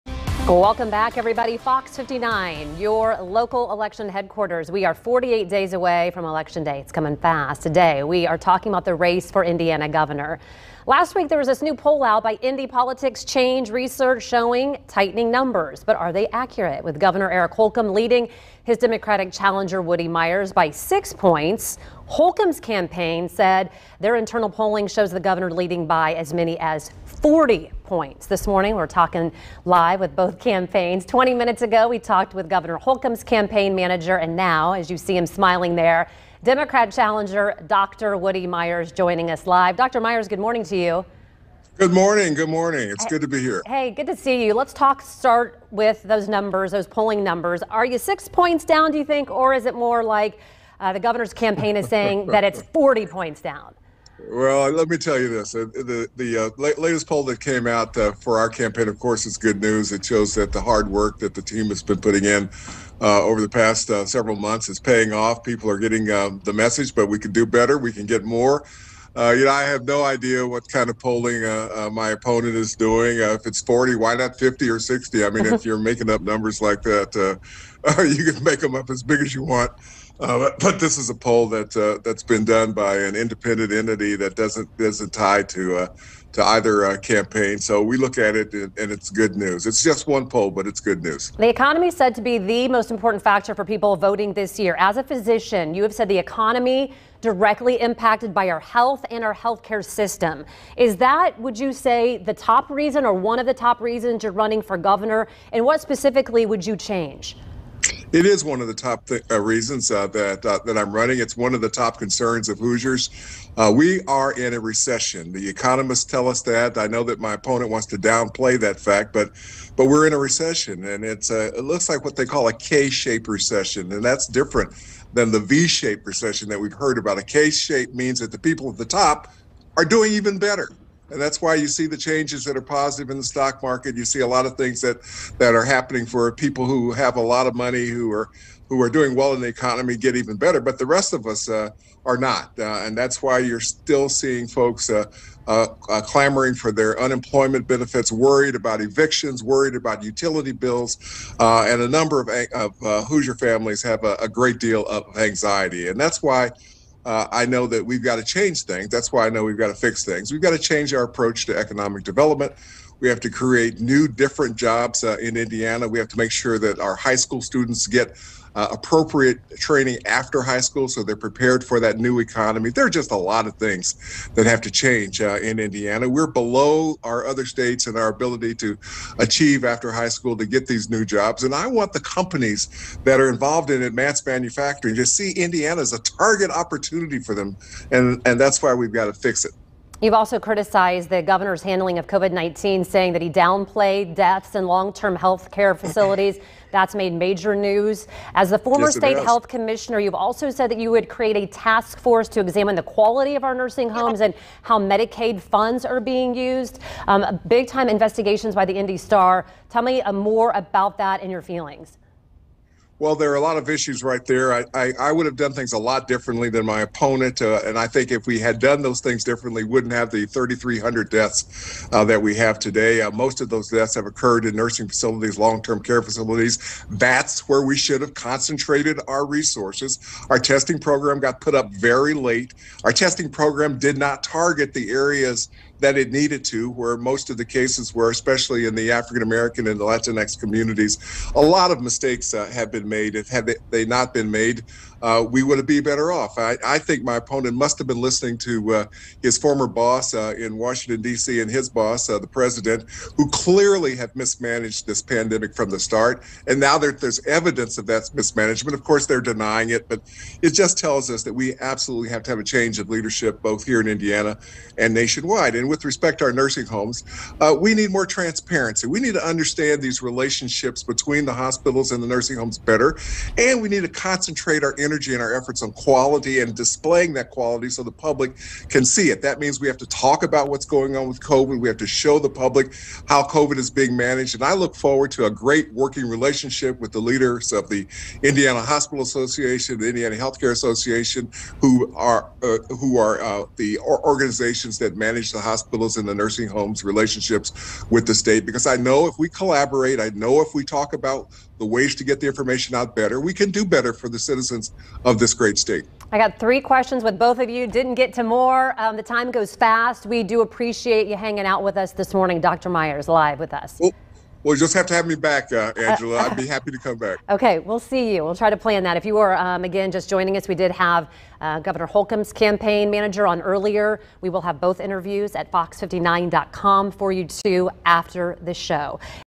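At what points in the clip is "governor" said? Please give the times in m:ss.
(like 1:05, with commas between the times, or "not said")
0:09, 0:16, 0:25, 0:32, 0:50, 1:44, 3:11, 5:21.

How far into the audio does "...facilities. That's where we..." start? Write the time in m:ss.
3:46.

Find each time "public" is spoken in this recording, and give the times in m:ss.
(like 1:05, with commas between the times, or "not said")
4:37, 4:42.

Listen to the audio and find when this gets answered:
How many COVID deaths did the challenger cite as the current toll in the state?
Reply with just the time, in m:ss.
3:40.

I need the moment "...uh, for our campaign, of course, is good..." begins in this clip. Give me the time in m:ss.
0:57.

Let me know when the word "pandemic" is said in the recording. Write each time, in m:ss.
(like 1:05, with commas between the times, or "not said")
4:15.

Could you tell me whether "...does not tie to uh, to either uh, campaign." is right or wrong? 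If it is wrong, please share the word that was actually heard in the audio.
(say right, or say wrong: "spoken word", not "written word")
right.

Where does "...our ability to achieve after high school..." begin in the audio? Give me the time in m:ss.
2:57.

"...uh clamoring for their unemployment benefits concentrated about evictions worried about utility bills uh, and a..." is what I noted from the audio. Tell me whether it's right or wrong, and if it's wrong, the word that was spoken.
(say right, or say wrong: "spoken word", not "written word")
wrong: "worried", not "concentrated".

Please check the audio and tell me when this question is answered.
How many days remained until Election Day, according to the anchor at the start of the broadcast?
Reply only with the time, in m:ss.
0:04.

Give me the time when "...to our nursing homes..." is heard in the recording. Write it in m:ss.
4:26.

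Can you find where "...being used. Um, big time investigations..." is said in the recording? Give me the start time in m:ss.
3:25.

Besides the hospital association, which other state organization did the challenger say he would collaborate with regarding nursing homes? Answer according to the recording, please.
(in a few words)
Indiana Healthcare Association.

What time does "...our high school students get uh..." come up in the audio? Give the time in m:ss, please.
2:46.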